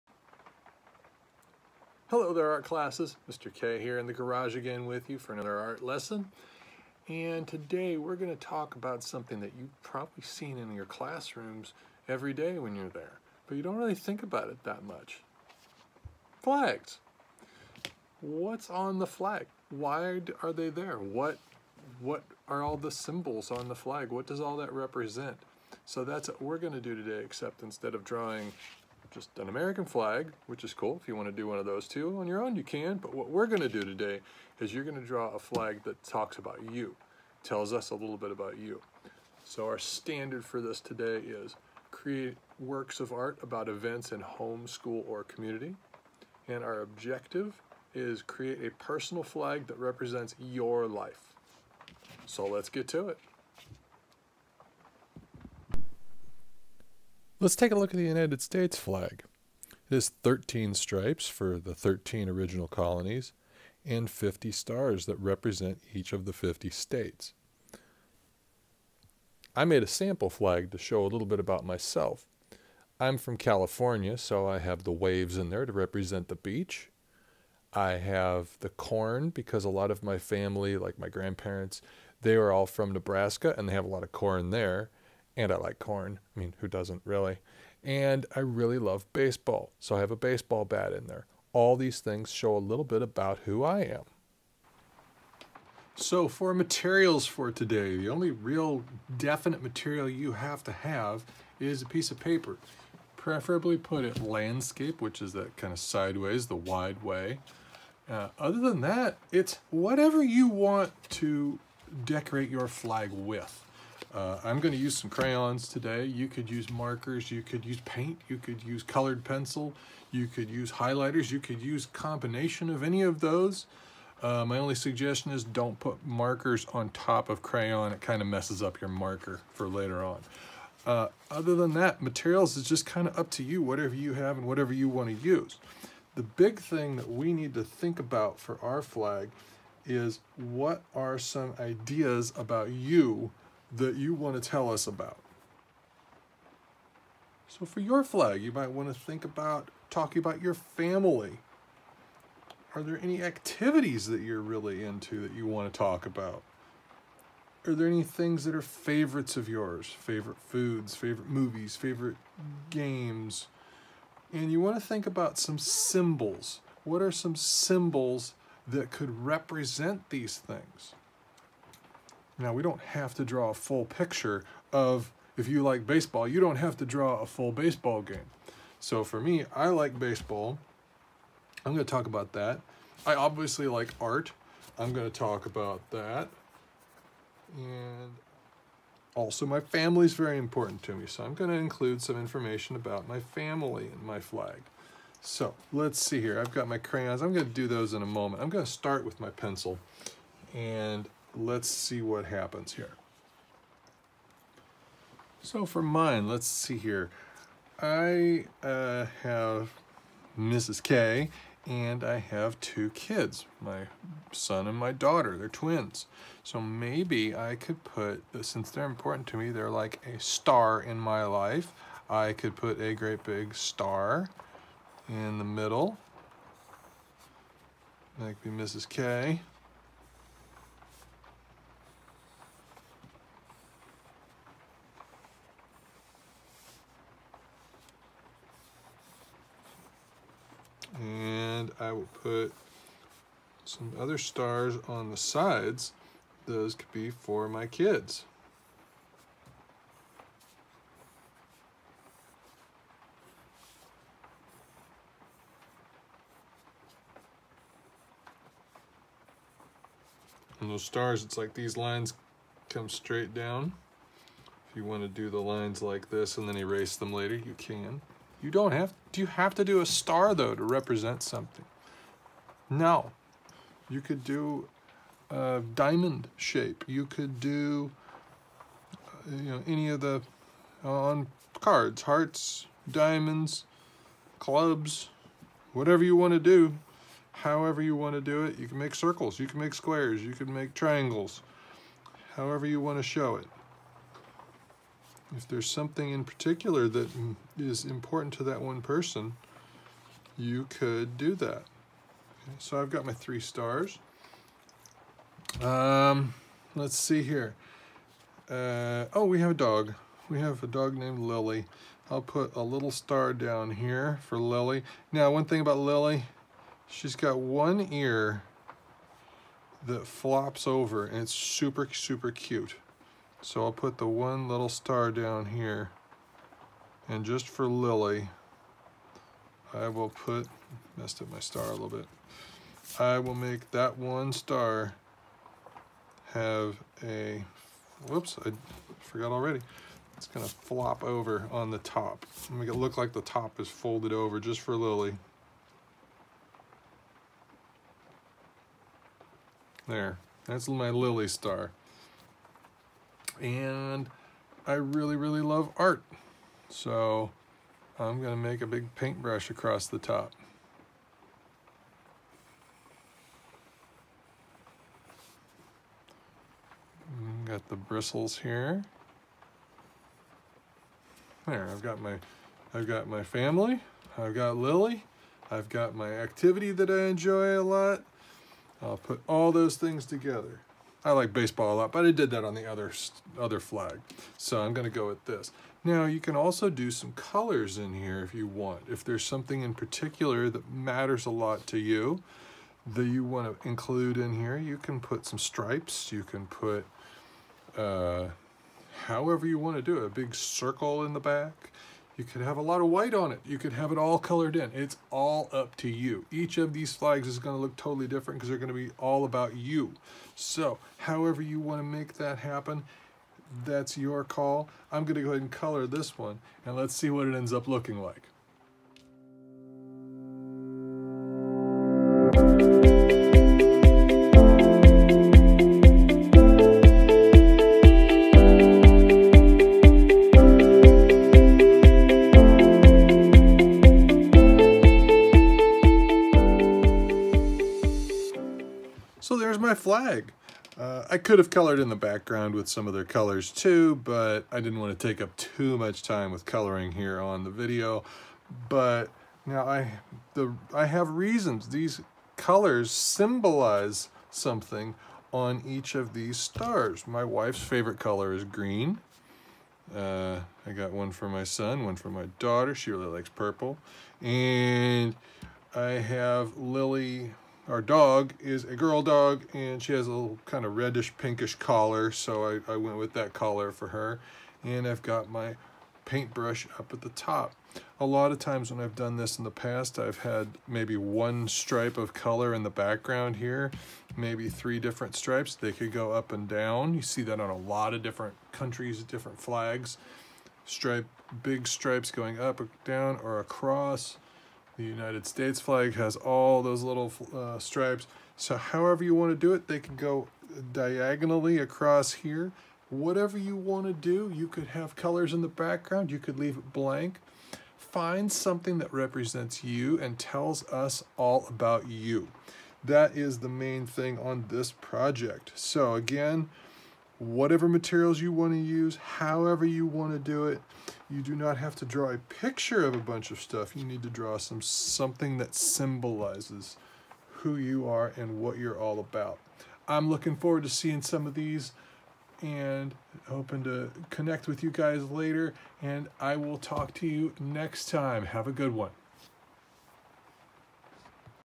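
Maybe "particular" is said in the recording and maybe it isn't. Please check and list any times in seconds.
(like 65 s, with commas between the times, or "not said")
296 s, 389 s.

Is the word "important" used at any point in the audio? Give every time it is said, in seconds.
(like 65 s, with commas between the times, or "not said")
190 s, 218 s, 297 s.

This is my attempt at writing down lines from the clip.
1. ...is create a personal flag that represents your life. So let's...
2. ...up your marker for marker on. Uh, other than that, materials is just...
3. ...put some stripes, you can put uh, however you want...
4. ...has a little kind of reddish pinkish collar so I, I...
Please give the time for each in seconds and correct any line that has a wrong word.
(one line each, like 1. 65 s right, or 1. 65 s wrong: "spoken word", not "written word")
1. 47 s right
2. 128 s wrong: "later", not "marker"
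3. 394 s right
4. 469 s right.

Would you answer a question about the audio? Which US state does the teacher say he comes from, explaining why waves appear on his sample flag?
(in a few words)
California.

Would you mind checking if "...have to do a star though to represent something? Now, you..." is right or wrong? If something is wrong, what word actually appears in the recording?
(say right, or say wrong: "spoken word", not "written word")
right.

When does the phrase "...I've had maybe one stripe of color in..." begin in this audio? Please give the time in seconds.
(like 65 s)
479 s.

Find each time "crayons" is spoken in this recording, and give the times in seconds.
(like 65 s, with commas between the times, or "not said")
115 s, 127 s, 196 s.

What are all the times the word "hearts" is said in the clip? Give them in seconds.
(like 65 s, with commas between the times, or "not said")
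282 s.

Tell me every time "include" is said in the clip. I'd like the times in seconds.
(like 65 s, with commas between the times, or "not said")
191 s, 393 s.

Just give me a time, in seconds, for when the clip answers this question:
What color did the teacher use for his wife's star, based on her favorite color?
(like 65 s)
458 s.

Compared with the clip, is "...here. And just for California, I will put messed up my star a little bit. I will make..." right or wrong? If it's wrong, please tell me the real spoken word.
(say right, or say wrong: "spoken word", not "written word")
wrong: "Lily", not "California".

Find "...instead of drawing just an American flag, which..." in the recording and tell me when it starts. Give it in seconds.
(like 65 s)
27 s.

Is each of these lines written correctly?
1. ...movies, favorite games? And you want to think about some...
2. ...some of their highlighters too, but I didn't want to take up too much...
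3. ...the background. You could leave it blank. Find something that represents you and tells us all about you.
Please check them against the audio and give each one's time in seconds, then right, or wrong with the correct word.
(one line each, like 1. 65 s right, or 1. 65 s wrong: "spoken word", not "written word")
1. 161 s right
2. 442 s wrong: "colors", not "highlighters"
3. 505 s right.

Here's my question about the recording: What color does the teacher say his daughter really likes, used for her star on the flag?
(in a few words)
Purple.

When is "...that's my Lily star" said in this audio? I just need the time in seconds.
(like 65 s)
350 s.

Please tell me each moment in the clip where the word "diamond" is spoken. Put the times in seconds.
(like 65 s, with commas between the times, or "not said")
275 s, 282 s.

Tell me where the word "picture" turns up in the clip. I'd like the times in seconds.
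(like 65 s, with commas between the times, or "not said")
173 s, 522 s.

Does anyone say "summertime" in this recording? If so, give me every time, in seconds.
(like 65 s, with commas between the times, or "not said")
not said.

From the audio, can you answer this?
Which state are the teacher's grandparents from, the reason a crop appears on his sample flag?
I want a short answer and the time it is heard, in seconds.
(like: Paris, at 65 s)
Nebraska, at 82 s.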